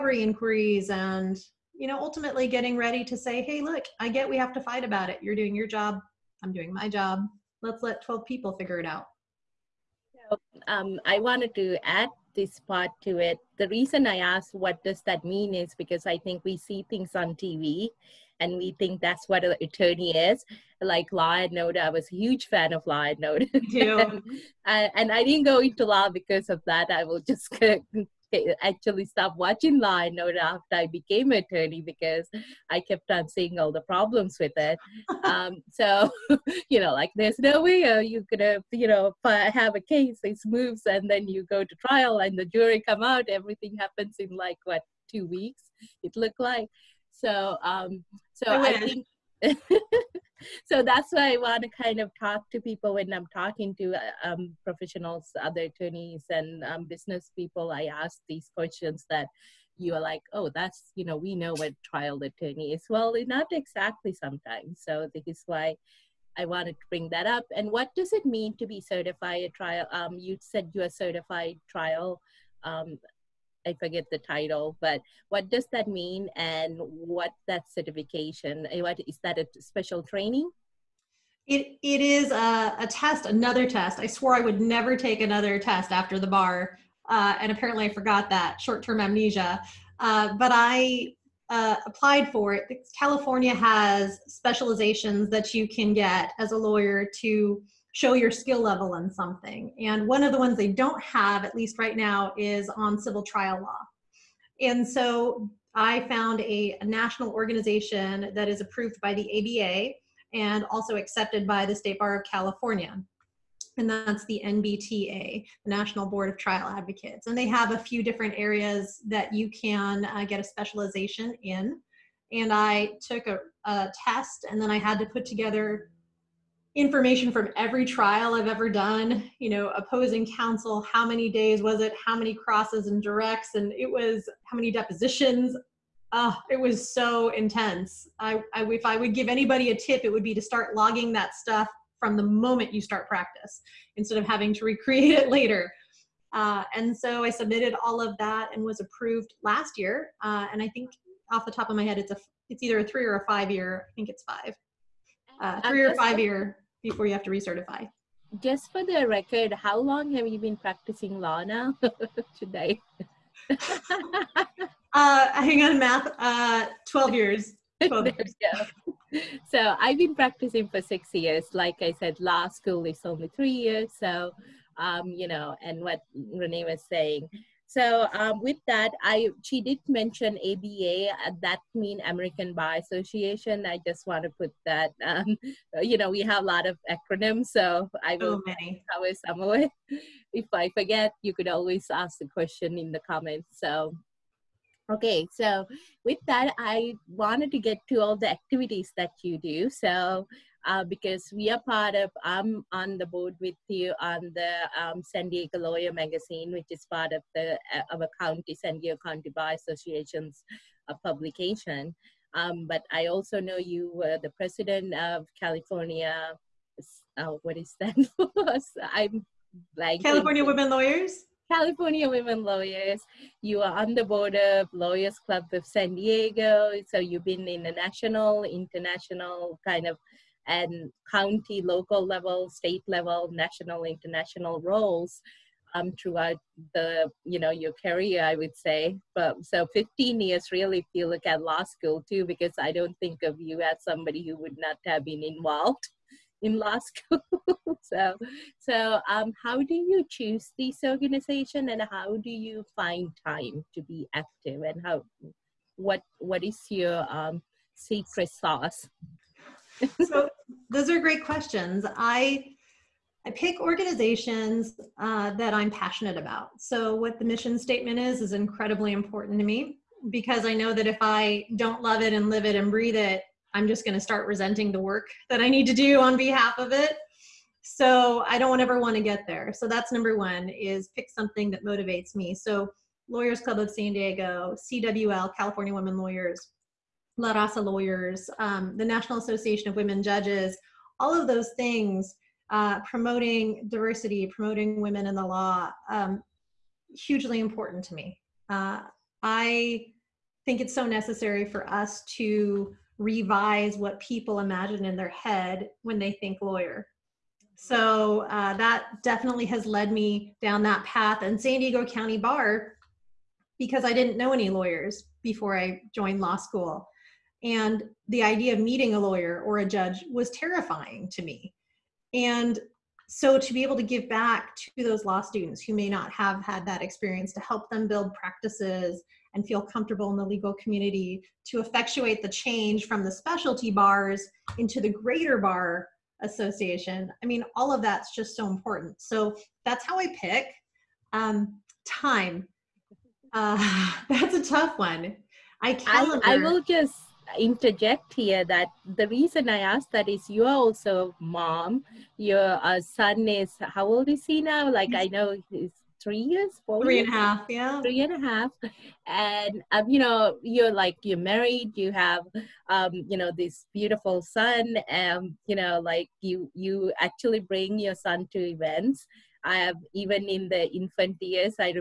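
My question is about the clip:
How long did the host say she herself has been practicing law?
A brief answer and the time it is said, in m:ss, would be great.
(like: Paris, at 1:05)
6 years, at 2:50.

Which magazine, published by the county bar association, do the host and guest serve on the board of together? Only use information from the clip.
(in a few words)
San Diego Lawyer Magazine.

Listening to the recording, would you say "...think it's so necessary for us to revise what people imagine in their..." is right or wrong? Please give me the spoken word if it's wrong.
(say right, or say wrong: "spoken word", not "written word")
right.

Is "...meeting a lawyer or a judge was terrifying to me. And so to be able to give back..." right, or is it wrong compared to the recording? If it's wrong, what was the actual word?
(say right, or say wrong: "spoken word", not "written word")
right.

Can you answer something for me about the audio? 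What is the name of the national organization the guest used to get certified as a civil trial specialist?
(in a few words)
National Board of Trial Advocates.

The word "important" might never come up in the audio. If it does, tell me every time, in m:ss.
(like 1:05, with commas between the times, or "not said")
4:28, 4:57, 5:38.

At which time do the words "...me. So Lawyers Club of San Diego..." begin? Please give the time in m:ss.
4:42.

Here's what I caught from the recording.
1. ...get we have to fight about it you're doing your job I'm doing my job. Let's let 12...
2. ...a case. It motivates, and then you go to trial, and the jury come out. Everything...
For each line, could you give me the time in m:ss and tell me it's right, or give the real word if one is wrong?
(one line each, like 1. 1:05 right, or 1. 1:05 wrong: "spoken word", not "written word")
1. 0:04 right
2. 0:39 wrong: "moves", not "motivates".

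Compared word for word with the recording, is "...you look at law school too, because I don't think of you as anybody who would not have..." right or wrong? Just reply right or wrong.
wrong.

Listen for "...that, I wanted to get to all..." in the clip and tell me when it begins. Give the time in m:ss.
3:16.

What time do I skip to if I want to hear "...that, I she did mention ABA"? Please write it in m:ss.
2:58.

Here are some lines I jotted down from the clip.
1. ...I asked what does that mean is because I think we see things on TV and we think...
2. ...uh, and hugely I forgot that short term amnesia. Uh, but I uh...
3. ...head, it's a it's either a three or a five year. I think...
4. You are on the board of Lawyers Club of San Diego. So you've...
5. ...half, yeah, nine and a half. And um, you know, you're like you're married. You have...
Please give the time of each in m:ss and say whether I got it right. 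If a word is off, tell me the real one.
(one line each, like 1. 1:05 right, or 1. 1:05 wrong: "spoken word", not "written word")
1. 0:14 right
2. 1:27 wrong: "apparently", not "hugely"
3. 2:31 right
4. 3:43 right
5. 5:57 wrong: "three", not "nine".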